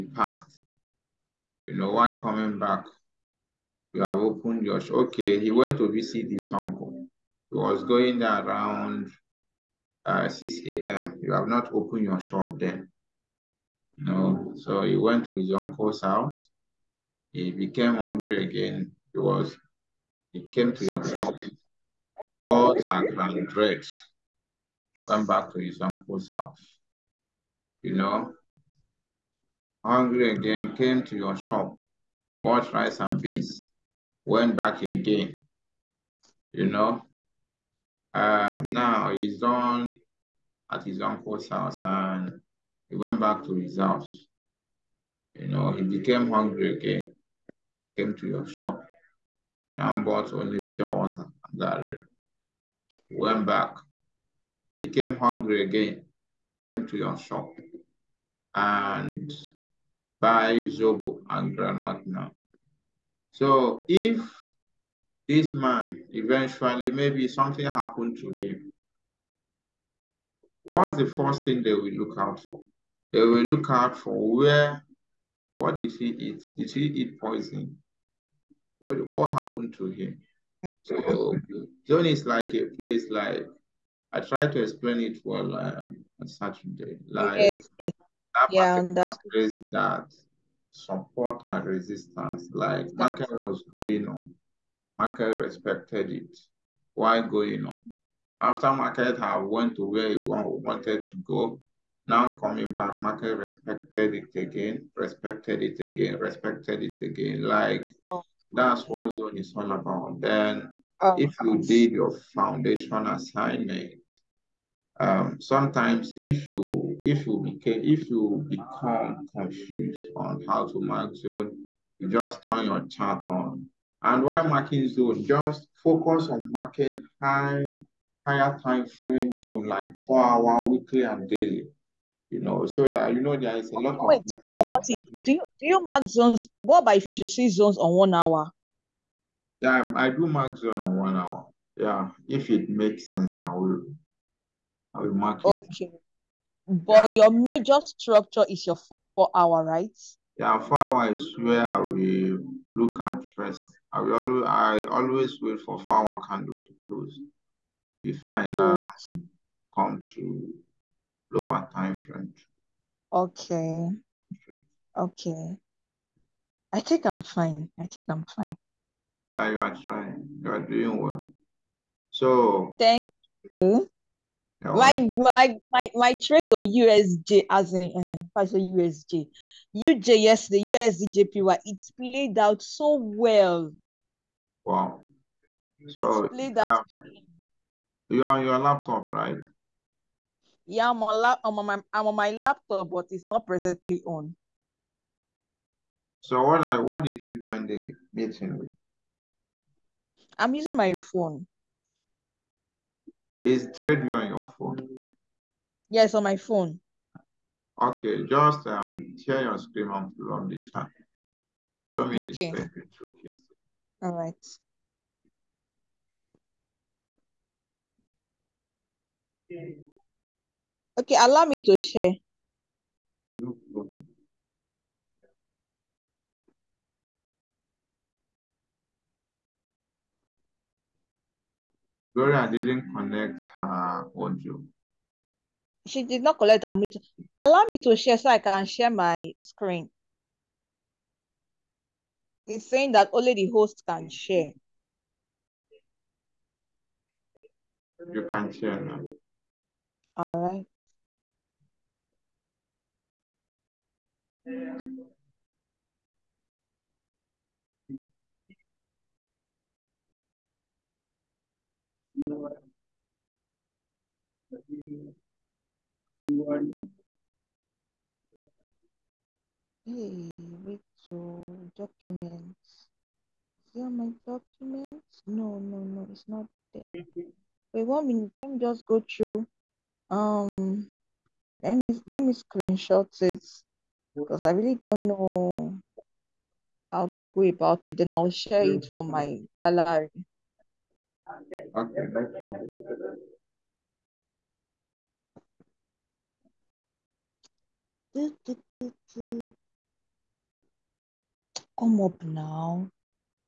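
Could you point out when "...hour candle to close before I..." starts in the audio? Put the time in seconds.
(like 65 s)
155 s.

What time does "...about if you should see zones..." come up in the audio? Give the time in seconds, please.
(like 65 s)
136 s.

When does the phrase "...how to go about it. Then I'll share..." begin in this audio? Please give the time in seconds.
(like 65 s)
286 s.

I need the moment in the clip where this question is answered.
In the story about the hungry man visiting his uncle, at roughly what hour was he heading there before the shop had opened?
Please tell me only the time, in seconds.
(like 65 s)
10 s.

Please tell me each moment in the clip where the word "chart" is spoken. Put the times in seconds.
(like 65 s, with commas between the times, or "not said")
122 s.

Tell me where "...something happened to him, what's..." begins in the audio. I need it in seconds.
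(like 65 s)
67 s.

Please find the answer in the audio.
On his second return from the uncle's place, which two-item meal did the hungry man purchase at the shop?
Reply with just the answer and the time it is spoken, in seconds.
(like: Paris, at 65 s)
Rice and beans, at 32 s.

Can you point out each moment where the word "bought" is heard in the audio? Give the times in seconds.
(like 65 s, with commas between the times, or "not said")
32 s, 50 s.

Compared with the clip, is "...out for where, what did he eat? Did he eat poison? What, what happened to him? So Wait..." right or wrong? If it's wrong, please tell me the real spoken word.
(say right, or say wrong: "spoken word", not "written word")
wrong: "John", not "Wait".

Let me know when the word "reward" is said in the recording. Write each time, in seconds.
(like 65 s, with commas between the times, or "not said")
not said.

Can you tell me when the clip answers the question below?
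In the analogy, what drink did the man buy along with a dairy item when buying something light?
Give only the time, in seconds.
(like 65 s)
50 s.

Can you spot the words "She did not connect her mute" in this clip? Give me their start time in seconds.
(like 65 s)
235 s.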